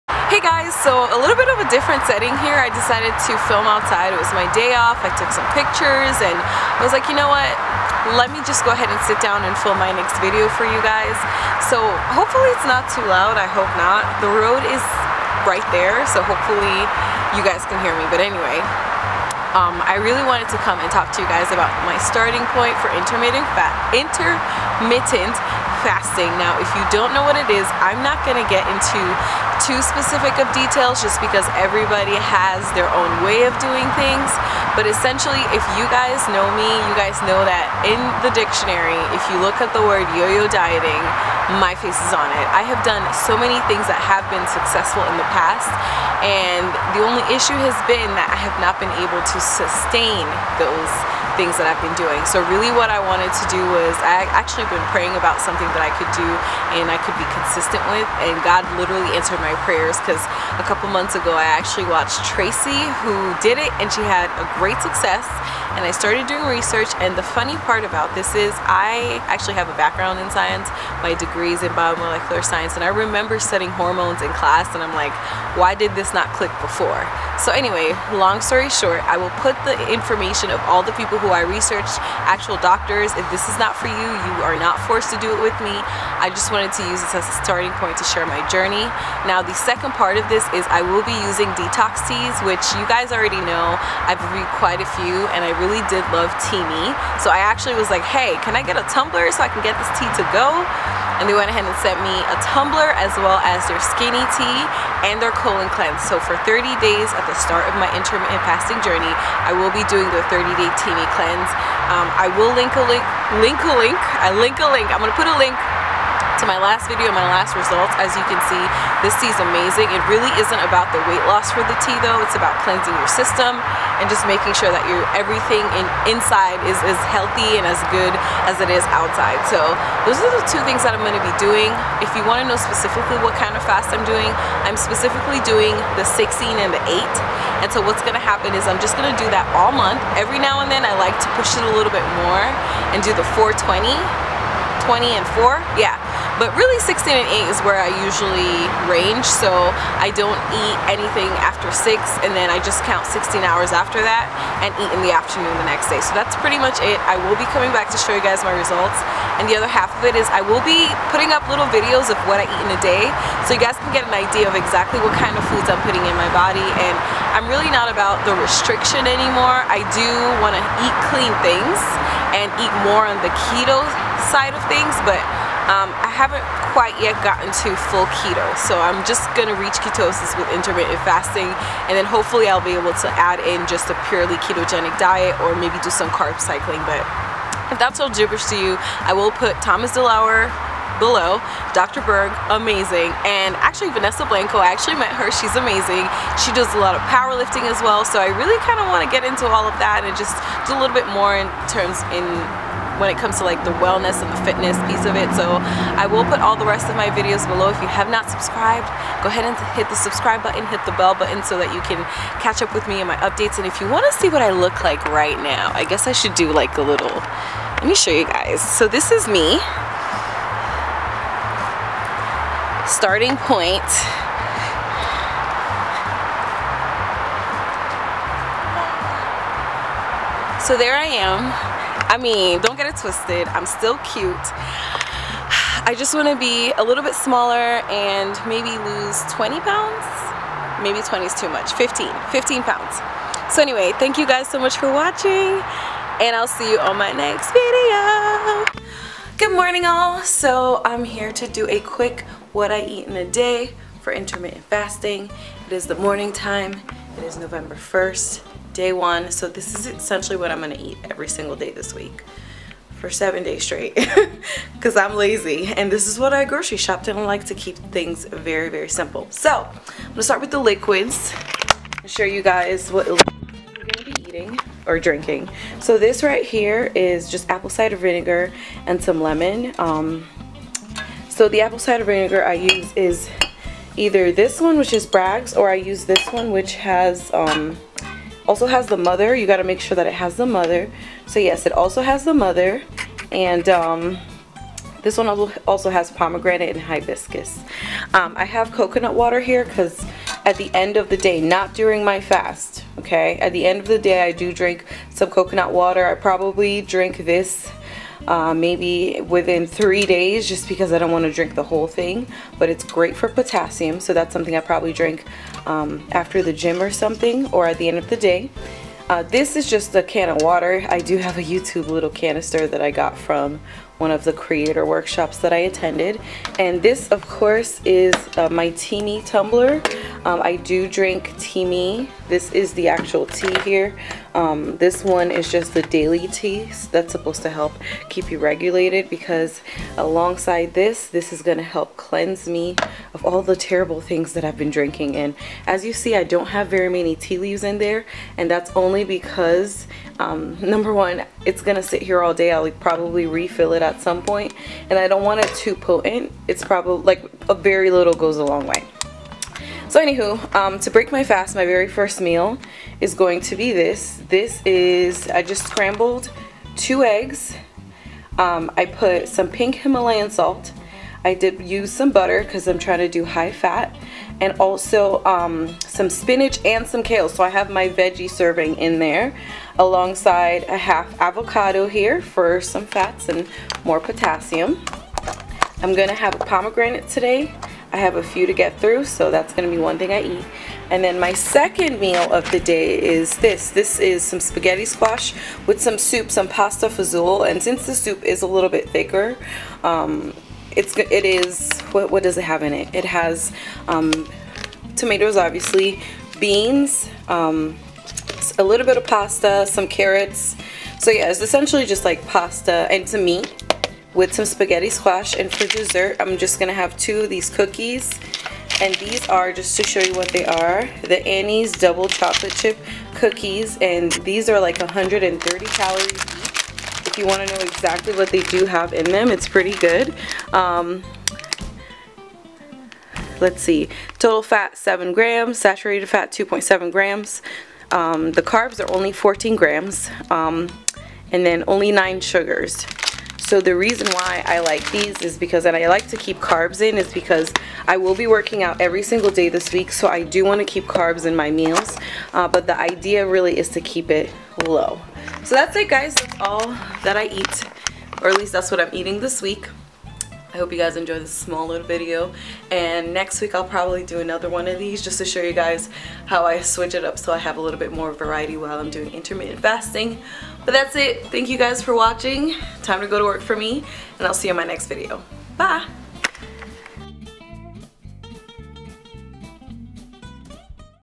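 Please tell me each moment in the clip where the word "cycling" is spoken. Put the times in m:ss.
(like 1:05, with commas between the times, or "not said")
3:06.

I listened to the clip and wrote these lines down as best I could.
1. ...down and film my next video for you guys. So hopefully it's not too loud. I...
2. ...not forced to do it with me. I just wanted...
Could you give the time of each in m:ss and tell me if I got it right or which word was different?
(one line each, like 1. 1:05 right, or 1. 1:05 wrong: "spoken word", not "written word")
1. 0:09 right
2. 1:24 right.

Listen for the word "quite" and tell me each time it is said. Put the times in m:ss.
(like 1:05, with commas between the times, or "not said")
1:34, 2:56.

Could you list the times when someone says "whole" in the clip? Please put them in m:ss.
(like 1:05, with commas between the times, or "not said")
5:11.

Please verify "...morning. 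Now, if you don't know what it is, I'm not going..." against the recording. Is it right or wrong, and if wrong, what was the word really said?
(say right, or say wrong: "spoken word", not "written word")
wrong: "fasting", not "morning".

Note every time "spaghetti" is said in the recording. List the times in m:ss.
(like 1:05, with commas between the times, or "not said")
6:34, 6:54.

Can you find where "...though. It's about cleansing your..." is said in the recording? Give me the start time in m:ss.
2:02.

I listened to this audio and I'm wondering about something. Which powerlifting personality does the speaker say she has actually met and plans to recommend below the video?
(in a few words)
Vanessa Blanco.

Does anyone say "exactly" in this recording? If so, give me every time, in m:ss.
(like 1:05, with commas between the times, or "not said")
2:44, 7:07.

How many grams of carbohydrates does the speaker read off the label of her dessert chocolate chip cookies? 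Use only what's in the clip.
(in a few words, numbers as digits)
14 grams.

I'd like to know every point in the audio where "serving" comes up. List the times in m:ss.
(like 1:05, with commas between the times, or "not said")
6:18.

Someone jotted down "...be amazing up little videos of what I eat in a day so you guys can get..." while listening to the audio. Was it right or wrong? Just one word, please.
wrong.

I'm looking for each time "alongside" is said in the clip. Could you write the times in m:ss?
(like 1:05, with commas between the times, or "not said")
5:39, 6:19.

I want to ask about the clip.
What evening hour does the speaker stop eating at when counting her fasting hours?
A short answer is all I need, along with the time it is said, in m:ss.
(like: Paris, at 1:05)
6, at 2:31.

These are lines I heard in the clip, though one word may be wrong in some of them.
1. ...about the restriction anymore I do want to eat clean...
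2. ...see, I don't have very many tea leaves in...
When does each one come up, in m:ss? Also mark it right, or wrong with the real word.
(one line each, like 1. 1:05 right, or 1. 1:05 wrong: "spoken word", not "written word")
1. 2:47 right
2. 5:45 right.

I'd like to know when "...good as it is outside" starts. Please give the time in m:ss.
2:07.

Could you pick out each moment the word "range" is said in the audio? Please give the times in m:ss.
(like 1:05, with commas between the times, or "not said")
2:28.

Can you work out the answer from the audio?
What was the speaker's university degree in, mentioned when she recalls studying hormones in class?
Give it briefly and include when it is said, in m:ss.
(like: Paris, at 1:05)
Biomolecular science, at 1:11.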